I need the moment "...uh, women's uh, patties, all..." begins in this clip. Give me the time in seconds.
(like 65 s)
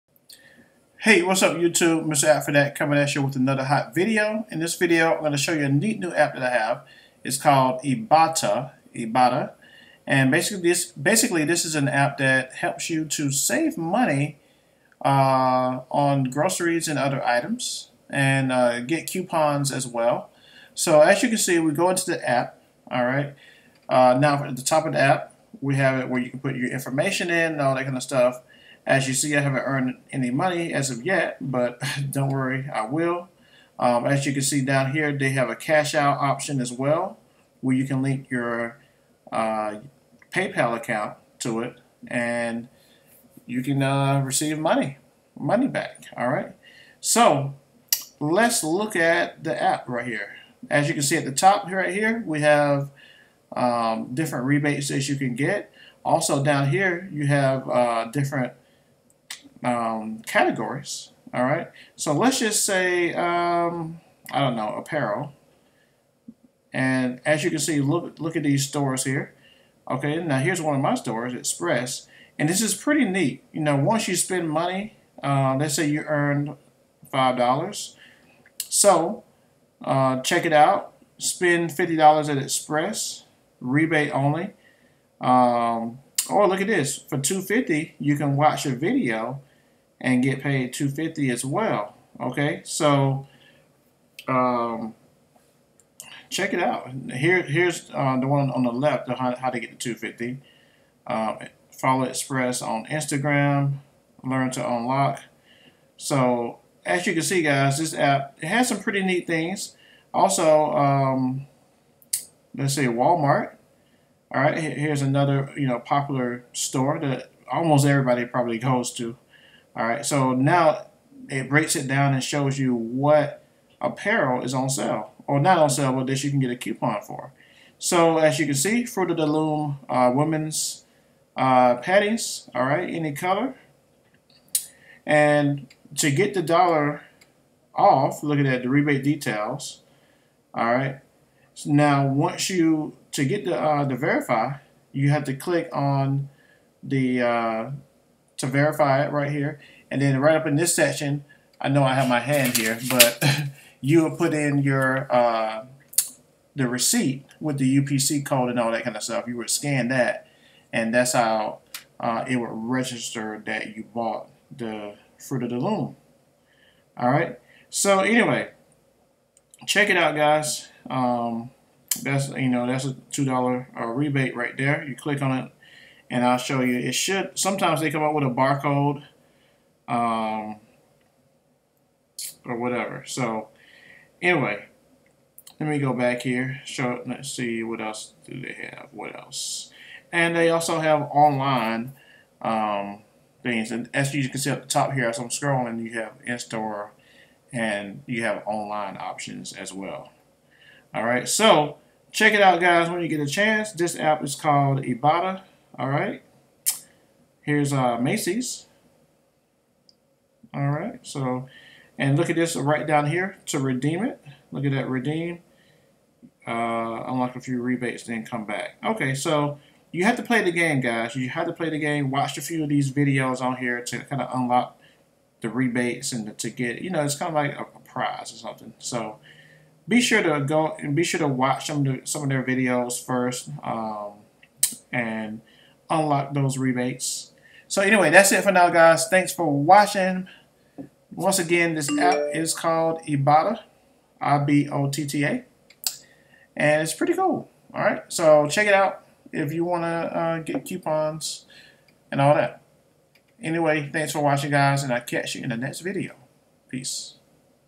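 129 s.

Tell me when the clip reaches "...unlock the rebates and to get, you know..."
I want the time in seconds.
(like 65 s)
224 s.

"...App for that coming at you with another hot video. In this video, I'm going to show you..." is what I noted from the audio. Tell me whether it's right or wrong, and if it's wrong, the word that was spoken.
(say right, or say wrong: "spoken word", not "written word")
right.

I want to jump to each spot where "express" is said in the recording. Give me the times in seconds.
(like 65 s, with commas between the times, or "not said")
71 s, 82 s, 102 s.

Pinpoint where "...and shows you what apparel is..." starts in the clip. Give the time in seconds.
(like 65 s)
122 s.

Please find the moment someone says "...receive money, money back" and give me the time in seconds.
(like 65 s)
44 s.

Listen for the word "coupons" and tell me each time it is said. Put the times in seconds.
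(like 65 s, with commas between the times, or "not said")
19 s, 126 s, 250 s.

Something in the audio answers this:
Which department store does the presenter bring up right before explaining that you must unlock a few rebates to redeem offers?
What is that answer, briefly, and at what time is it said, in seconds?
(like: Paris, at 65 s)
Macy's, at 207 s.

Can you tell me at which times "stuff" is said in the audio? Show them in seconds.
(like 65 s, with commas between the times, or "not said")
28 s, 159 s.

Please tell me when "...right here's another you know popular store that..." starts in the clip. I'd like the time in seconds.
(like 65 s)
114 s.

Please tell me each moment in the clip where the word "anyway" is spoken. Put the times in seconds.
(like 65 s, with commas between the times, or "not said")
167 s, 184 s, 237 s, 253 s.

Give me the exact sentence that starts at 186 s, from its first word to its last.
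Show, let's see what else do they have.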